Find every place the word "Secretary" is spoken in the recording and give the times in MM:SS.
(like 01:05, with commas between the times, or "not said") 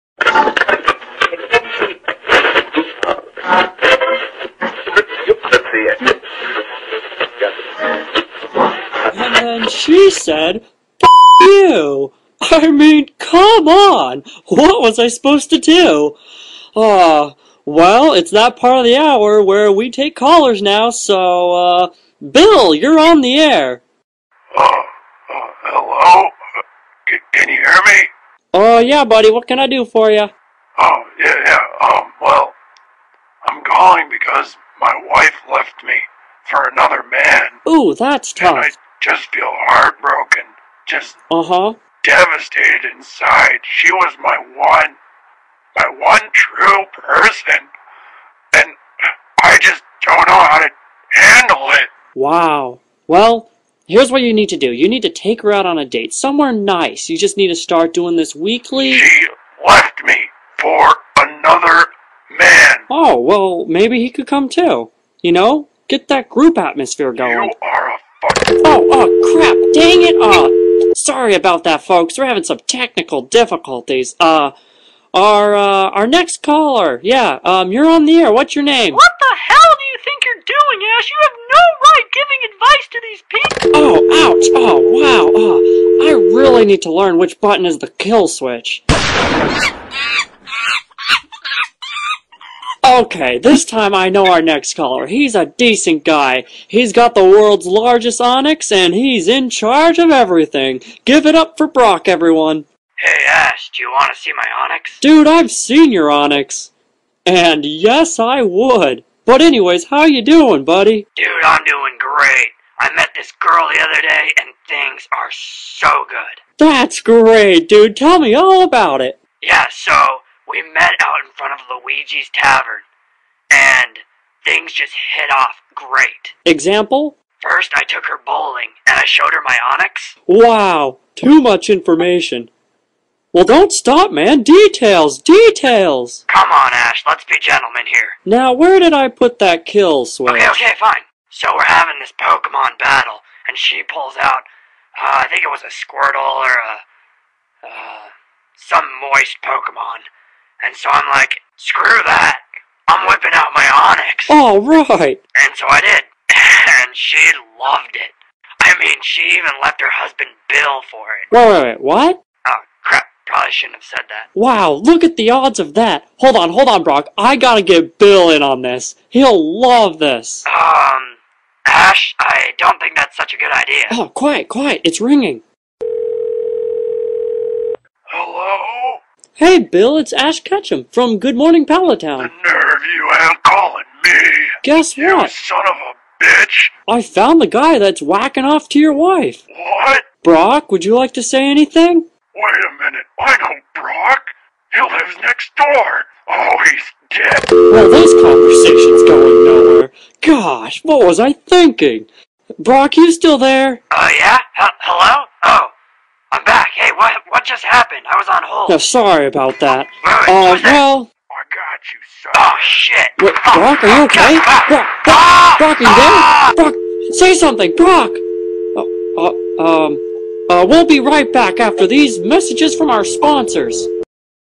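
not said.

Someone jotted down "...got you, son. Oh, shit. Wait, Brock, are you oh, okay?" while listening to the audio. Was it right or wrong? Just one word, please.
right.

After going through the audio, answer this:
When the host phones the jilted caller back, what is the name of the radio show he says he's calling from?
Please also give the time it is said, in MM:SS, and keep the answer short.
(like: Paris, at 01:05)
Good Morning Pallet Town, at 03:01.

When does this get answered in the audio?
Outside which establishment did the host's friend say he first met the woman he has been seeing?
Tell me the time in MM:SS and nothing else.
02:01.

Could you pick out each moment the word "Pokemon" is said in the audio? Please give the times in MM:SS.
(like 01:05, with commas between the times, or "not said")
02:22, 02:29.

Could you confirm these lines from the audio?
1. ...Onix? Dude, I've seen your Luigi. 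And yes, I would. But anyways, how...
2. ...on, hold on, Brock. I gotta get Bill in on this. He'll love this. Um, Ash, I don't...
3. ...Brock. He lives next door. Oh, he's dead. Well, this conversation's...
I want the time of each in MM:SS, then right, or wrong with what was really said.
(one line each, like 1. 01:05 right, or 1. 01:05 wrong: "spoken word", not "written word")
1. 01:44 wrong: "Onix", not "Luigi"
2. 02:46 right
3. 03:13 right.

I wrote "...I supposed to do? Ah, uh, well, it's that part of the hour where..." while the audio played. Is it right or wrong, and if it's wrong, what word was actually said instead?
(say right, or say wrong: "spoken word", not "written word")
right.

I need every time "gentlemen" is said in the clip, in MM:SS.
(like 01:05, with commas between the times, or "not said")
02:17.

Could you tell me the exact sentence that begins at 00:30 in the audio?
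Oh, yeah, yeah, um, well, I'm calling because my wife left me for another man.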